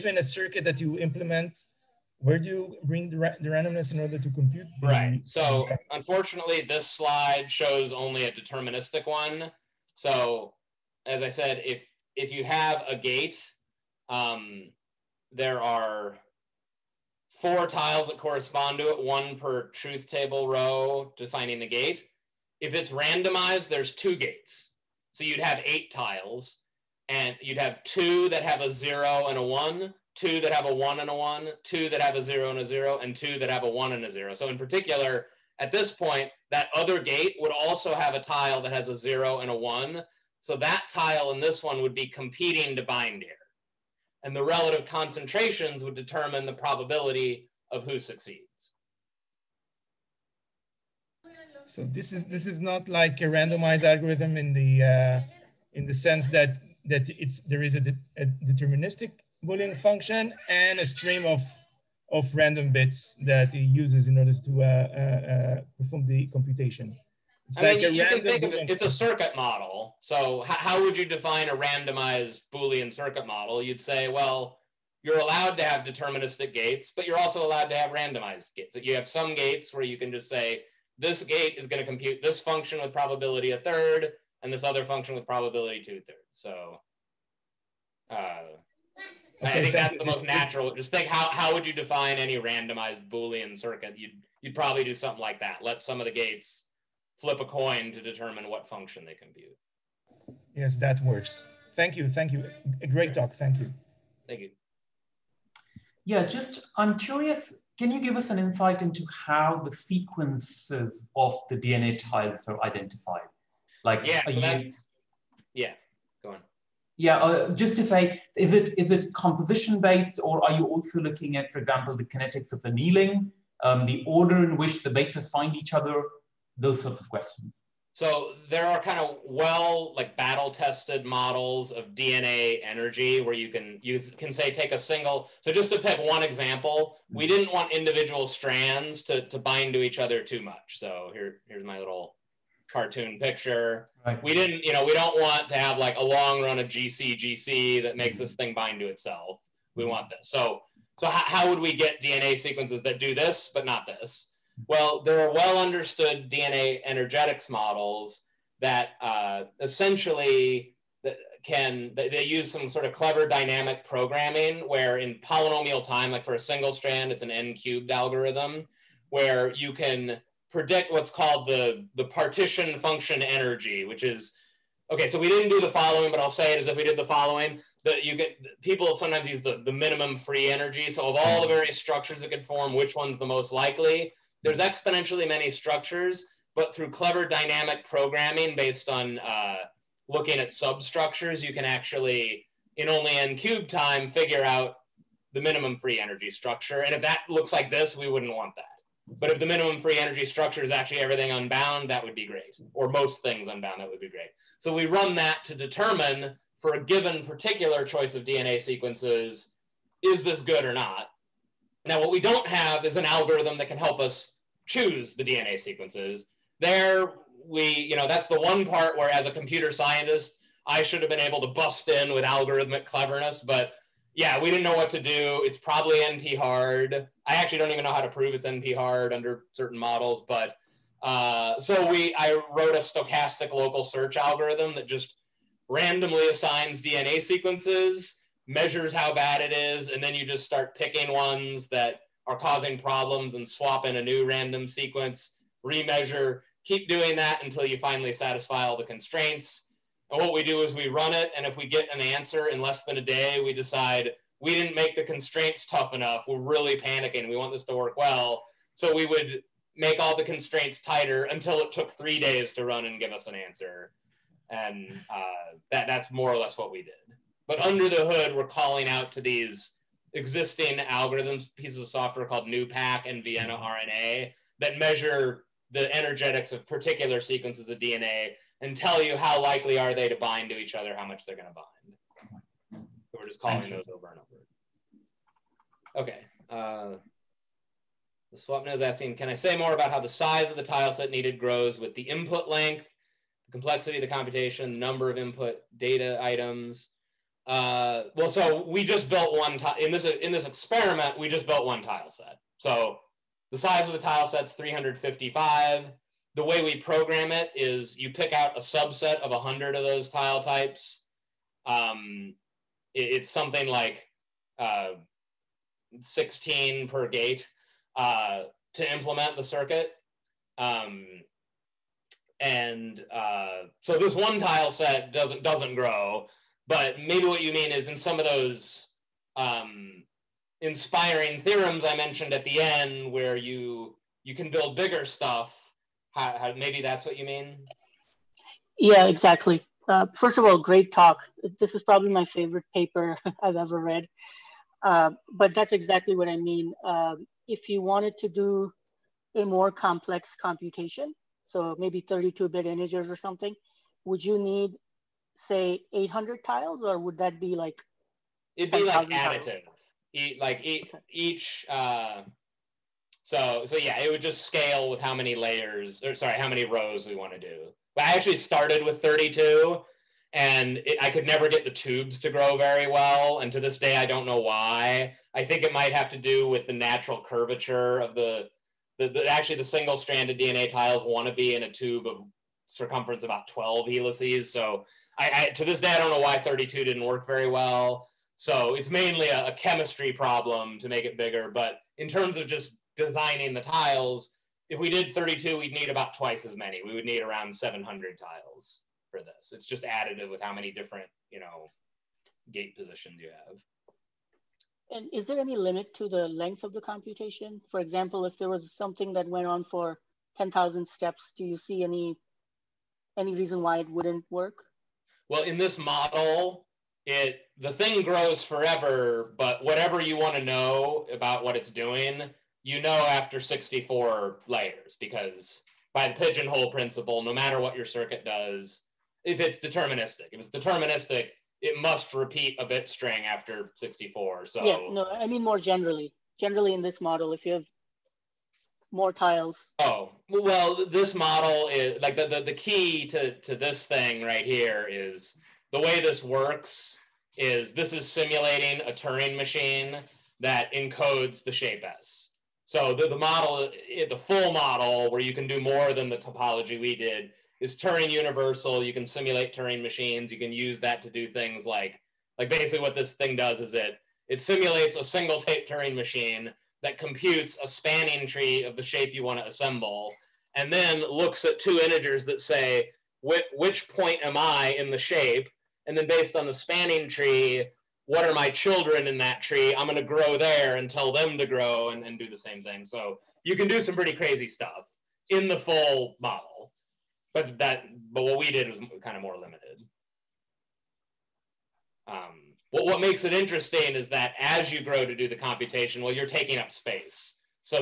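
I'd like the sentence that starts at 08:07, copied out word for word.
But that, but what we did was kind of more limited.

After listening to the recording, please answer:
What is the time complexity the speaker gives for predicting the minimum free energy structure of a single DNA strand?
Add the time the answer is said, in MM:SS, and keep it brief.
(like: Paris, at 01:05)
n cubed, at 02:47.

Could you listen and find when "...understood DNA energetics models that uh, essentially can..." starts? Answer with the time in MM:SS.
02:35.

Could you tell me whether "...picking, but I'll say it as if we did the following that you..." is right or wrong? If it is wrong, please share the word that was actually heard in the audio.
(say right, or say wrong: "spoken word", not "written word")
wrong: "following", not "picking".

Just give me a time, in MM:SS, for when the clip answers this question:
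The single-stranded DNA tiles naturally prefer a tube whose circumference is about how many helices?
06:23.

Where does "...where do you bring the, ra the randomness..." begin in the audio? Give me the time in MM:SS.
00:02.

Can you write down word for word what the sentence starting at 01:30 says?
Just think how, how would you define any randomized Boolean circuit?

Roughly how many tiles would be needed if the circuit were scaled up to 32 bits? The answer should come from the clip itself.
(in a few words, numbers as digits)
700.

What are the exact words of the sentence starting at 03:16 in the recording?
And if that looks like this, we wouldn't want that.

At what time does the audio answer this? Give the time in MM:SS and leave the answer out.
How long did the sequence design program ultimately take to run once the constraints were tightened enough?
04:21.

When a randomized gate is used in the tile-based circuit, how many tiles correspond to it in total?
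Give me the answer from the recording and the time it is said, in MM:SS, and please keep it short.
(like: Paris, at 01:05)
8, at 00:25.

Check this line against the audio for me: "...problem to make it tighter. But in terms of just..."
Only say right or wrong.
wrong.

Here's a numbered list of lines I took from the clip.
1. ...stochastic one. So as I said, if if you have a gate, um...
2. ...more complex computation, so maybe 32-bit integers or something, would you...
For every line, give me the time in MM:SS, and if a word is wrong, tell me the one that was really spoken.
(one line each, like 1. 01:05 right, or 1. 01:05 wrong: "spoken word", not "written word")
1. 00:08 wrong: "deterministic", not "stochastic"
2. 05:49 right.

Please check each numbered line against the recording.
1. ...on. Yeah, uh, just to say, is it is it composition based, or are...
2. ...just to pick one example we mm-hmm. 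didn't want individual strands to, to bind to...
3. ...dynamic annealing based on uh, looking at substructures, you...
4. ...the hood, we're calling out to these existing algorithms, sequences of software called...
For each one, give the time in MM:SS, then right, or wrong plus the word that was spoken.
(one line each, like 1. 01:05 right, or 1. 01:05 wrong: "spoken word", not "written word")
1. 01:56 right
2. 02:15 right
3. 03:07 wrong: "programming", not "annealing"
4. 04:27 wrong: "pieces", not "sequences".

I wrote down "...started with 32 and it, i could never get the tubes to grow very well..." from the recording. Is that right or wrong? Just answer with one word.
right.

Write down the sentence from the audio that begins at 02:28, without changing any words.
this thing bind to itself we mm-hmm.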